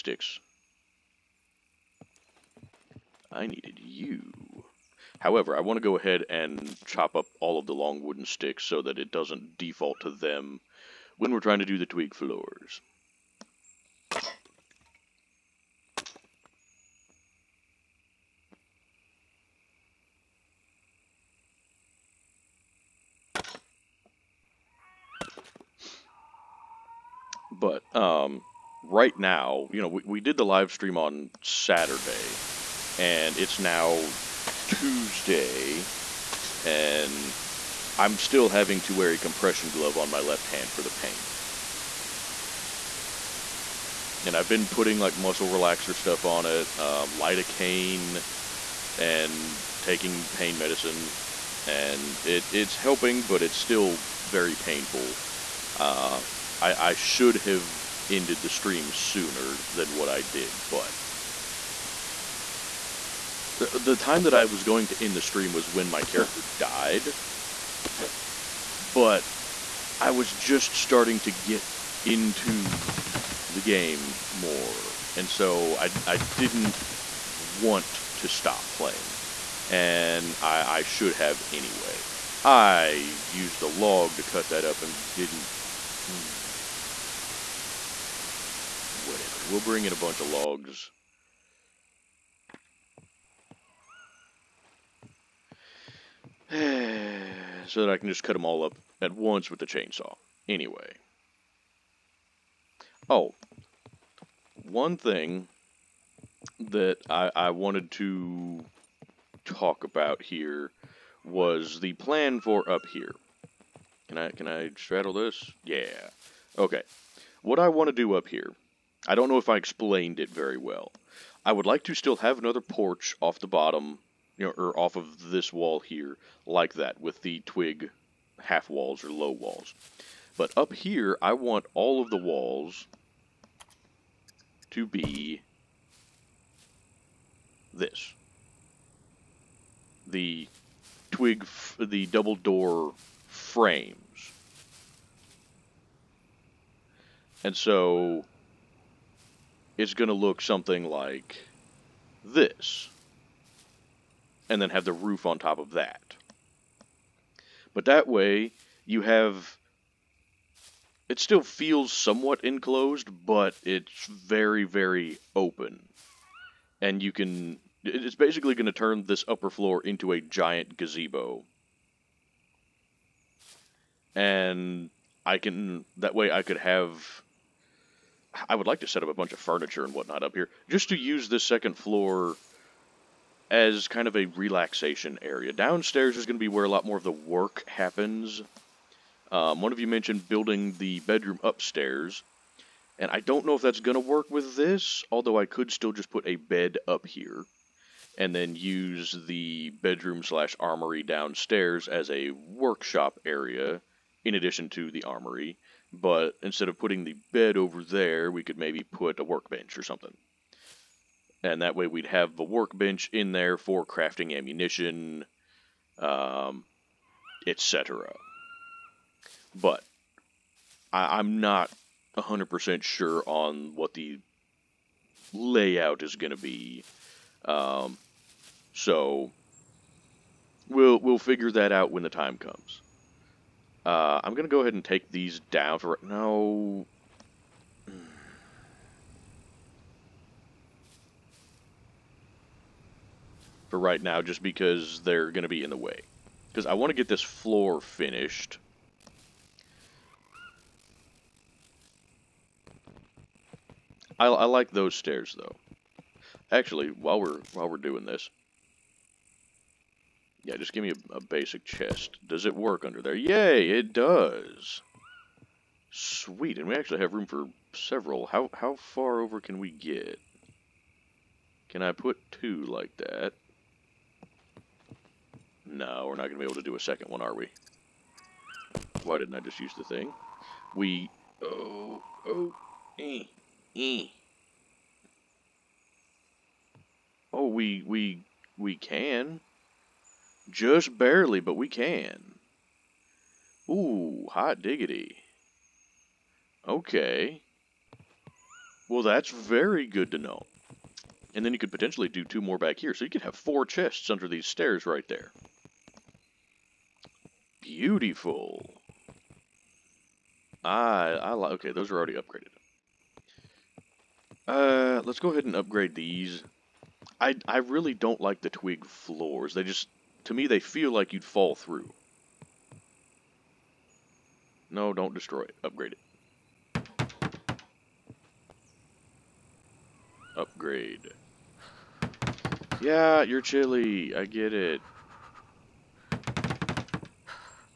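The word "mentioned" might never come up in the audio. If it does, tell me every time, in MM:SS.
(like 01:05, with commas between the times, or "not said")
03:09.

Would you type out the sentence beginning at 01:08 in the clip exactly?
But I was just starting to get into the game more.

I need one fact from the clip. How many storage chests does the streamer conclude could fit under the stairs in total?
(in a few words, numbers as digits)
4.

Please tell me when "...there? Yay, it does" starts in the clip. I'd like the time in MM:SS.
04:23.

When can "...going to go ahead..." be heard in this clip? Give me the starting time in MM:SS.
03:54.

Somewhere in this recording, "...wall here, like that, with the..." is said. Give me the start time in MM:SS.
02:05.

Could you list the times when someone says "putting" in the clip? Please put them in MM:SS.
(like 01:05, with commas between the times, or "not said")
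00:44, 03:26.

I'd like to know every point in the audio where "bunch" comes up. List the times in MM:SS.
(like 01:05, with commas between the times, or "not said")
01:29, 02:59.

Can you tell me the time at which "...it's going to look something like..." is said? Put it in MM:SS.
02:29.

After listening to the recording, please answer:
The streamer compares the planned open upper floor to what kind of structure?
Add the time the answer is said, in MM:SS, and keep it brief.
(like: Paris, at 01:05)
a giant gazebo, at 02:50.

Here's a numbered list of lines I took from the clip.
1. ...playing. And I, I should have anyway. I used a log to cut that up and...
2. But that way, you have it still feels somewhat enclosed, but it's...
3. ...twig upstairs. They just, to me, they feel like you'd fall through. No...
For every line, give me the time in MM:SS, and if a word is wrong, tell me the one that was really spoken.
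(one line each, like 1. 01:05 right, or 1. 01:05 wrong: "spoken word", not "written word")
1. 01:18 right
2. 02:37 right
3. 05:18 wrong: "floors", not "upstairs".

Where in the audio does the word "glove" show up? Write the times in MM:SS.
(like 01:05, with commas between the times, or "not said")
00:39.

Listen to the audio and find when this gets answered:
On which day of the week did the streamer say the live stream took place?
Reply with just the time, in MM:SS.
00:31.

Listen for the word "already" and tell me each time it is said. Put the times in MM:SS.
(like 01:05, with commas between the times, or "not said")
05:11.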